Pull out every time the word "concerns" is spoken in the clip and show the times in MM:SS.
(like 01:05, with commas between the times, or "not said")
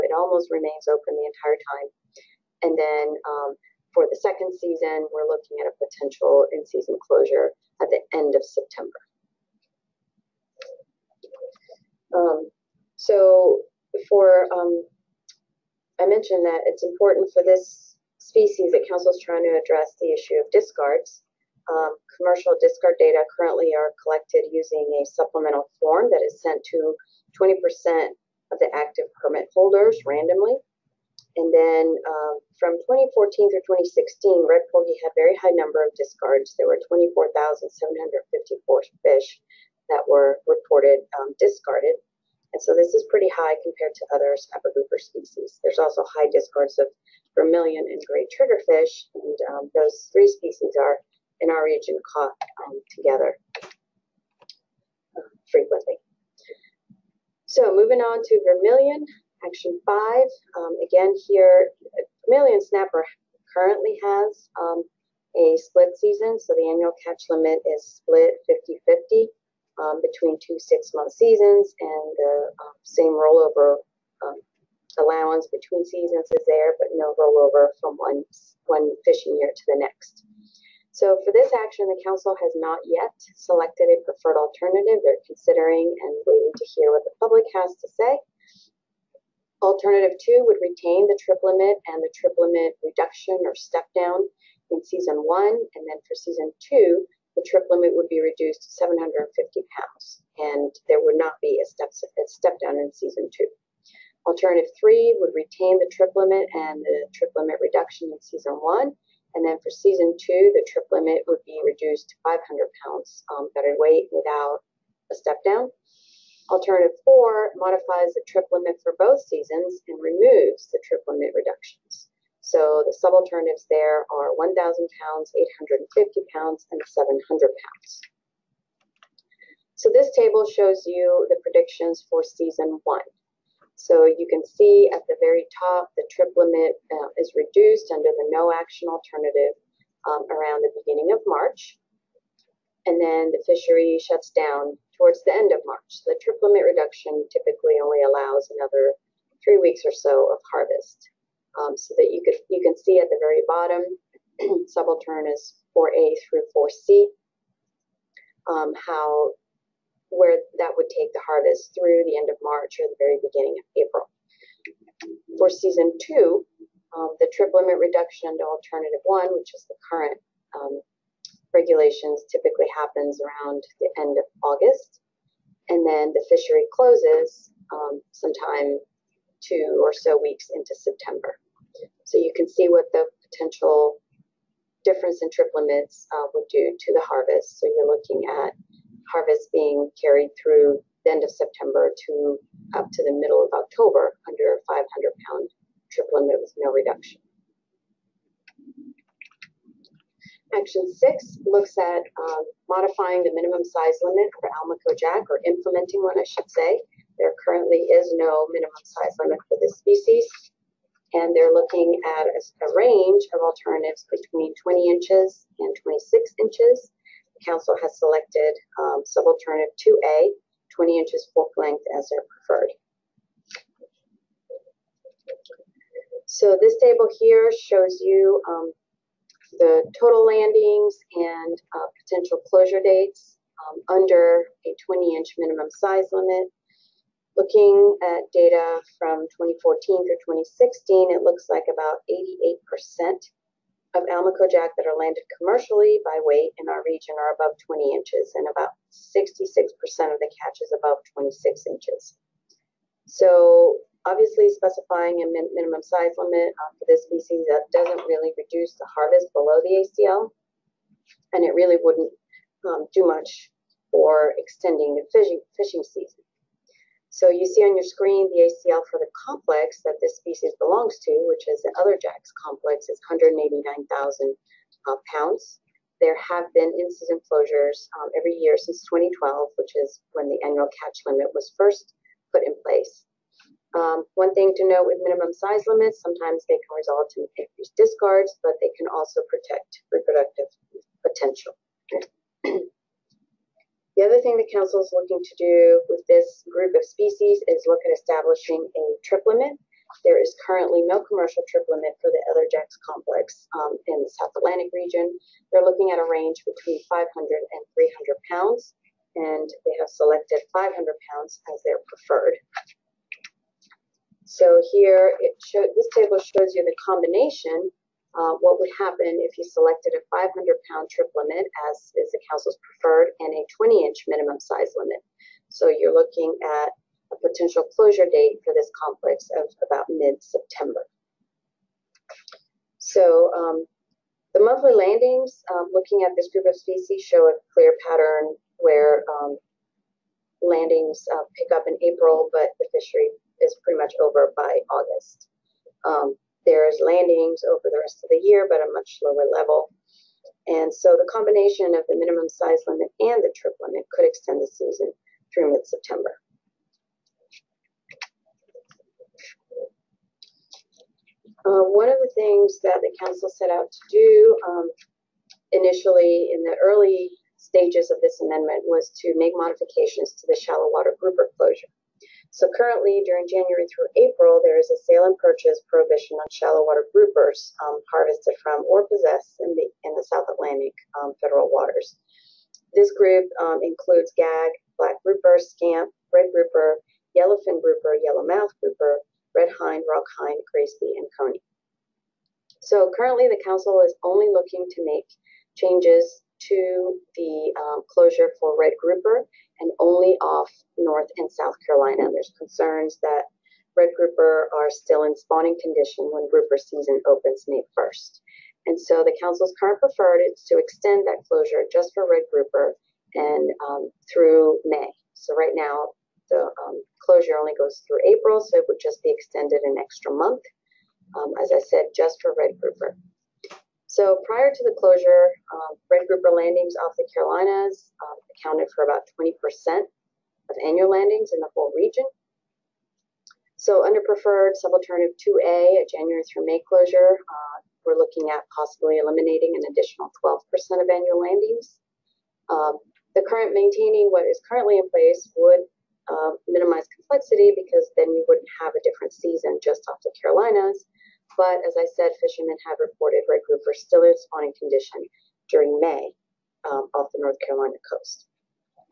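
06:42.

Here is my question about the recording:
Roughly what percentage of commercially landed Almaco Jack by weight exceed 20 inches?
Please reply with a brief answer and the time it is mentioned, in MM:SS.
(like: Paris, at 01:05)
88%, at 04:02.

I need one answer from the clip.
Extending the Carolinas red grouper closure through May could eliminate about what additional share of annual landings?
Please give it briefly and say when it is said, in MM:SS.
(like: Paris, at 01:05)
12%, at 07:20.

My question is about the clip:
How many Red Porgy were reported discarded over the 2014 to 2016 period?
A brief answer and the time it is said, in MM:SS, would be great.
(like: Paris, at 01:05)
24,754, at 00:36.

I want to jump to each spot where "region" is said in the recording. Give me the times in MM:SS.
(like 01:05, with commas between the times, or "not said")
00:51, 04:06, 05:04, 07:11.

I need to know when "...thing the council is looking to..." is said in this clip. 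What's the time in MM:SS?
04:54.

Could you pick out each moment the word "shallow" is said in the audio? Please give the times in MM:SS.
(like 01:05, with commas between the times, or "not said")
06:10, 06:16.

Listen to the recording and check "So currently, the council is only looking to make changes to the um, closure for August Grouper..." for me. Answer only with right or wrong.
wrong.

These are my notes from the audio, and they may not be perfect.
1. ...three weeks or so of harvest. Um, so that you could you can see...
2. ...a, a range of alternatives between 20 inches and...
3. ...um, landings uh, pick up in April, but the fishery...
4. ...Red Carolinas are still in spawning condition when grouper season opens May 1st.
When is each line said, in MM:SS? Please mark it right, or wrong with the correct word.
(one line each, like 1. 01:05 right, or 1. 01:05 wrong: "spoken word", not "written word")
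1. 02:29 right
2. 03:32 right
3. 05:39 right
4. 06:43 wrong: "Grouper", not "Carolinas".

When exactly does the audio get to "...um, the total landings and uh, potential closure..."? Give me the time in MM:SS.
03:48.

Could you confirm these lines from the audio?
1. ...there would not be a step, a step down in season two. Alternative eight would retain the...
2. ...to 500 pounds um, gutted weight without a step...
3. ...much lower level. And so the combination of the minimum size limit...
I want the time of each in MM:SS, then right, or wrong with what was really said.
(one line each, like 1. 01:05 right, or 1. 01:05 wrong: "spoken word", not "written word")
1. 01:40 wrong: "three", not "eight"
2. 01:52 right
3. 05:48 right.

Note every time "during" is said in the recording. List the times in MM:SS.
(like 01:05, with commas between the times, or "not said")
06:13, 07:35.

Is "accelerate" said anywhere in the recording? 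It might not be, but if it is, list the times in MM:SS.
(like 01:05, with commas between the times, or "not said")
not said.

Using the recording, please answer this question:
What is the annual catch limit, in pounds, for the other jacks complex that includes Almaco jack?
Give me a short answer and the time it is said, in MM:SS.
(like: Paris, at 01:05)
189,000, at 04:33.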